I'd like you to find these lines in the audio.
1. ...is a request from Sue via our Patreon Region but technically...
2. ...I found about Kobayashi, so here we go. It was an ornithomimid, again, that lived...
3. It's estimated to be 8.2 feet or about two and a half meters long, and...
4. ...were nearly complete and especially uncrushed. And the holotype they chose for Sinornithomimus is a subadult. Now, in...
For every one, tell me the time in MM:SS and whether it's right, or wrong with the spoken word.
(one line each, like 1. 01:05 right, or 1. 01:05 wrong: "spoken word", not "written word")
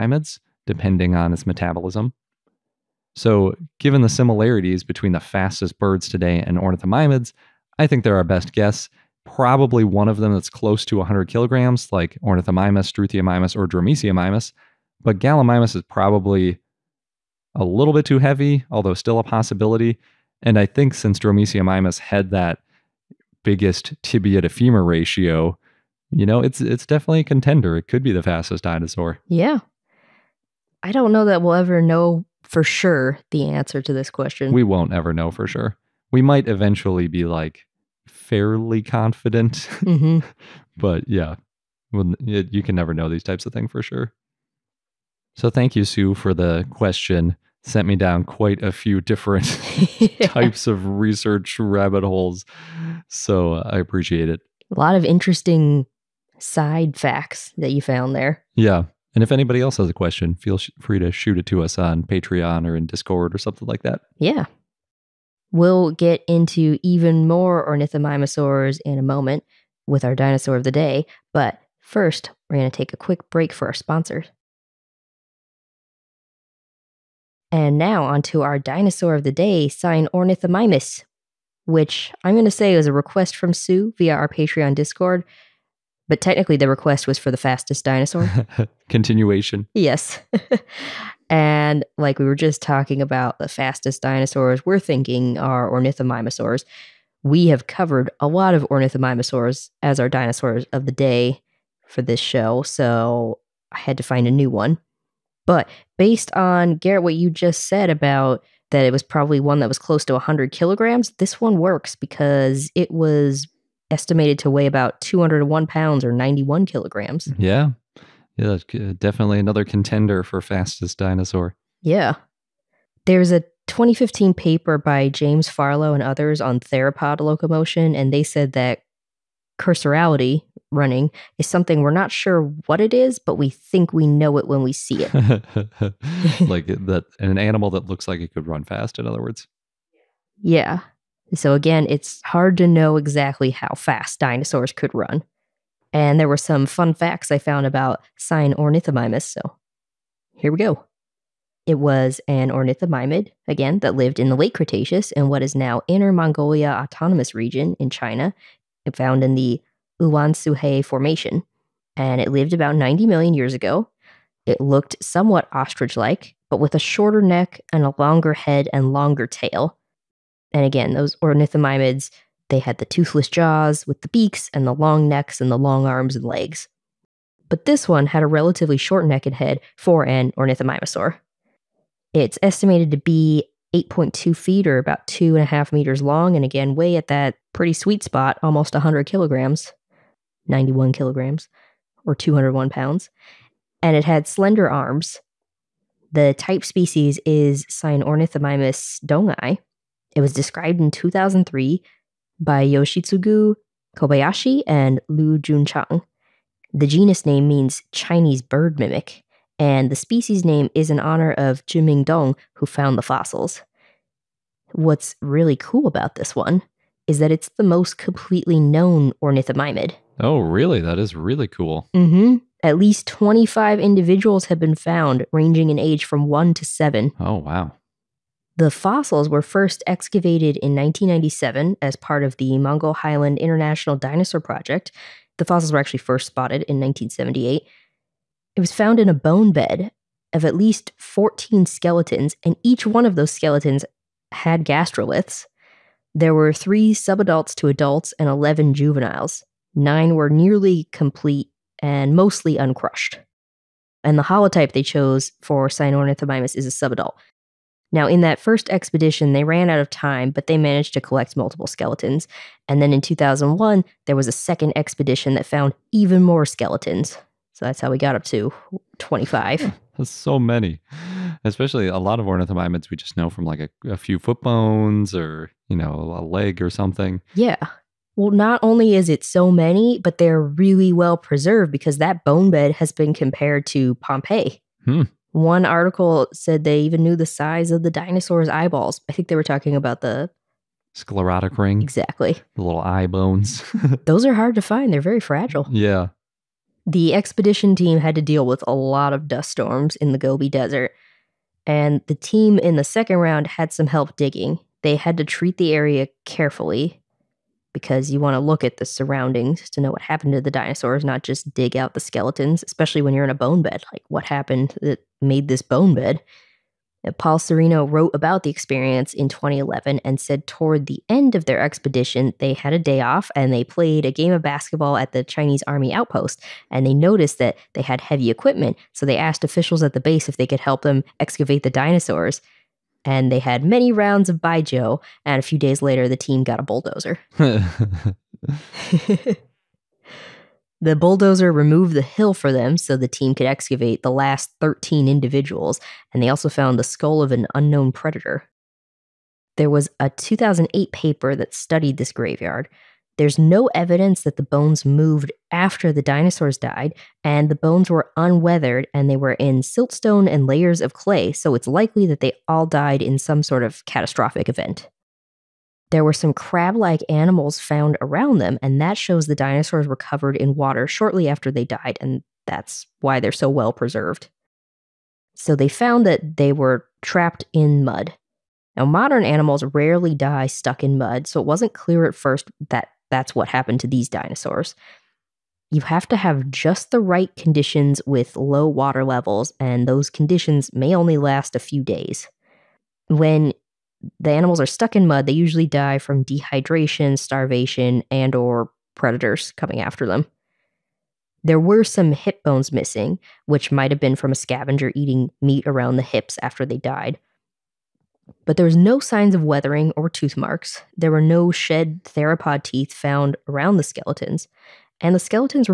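1. 01:22 wrong: "Discord", not "Region"
2. 02:27 wrong: "Sinornithomimus", not "Kobayashi"
3. 03:02 right
4. 04:10 wrong: "mostly", not "especially".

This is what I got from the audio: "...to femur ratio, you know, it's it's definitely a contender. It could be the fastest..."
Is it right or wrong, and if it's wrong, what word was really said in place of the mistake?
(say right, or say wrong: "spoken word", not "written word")
right.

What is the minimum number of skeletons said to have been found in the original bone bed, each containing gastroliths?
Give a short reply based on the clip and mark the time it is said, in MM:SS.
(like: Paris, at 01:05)
14, at 04:00.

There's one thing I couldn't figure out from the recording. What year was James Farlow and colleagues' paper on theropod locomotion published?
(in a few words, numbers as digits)
2015.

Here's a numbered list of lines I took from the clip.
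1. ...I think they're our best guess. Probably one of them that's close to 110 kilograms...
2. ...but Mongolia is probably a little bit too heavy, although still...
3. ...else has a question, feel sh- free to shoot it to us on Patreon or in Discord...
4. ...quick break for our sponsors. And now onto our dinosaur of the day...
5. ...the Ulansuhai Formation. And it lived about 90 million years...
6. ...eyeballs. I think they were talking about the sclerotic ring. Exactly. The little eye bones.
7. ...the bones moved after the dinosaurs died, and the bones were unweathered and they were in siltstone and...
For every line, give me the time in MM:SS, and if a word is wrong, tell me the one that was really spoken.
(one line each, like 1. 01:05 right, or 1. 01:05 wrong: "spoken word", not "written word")
1. 00:07 wrong: "100", not "110"
2. 00:15 wrong: "Gallimimus", not "Mongolia"
3. 00:59 right
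4. 01:12 right
5. 02:39 right
6. 04:48 right
7. 05:54 right.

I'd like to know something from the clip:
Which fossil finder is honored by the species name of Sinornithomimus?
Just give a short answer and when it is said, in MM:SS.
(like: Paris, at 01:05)
Zhiming Dong, at 03:31.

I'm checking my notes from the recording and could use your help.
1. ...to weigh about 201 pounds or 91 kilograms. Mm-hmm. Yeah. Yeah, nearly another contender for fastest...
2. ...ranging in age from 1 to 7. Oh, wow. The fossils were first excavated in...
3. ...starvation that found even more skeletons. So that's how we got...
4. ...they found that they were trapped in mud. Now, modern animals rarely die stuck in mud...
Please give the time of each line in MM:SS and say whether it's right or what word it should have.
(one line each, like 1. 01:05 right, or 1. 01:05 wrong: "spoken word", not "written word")
1. 01:54 wrong: "definitely", not "nearly"
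2. 03:45 right
3. 04:24 wrong: "expedition", not "starvation"
4. 06:15 right.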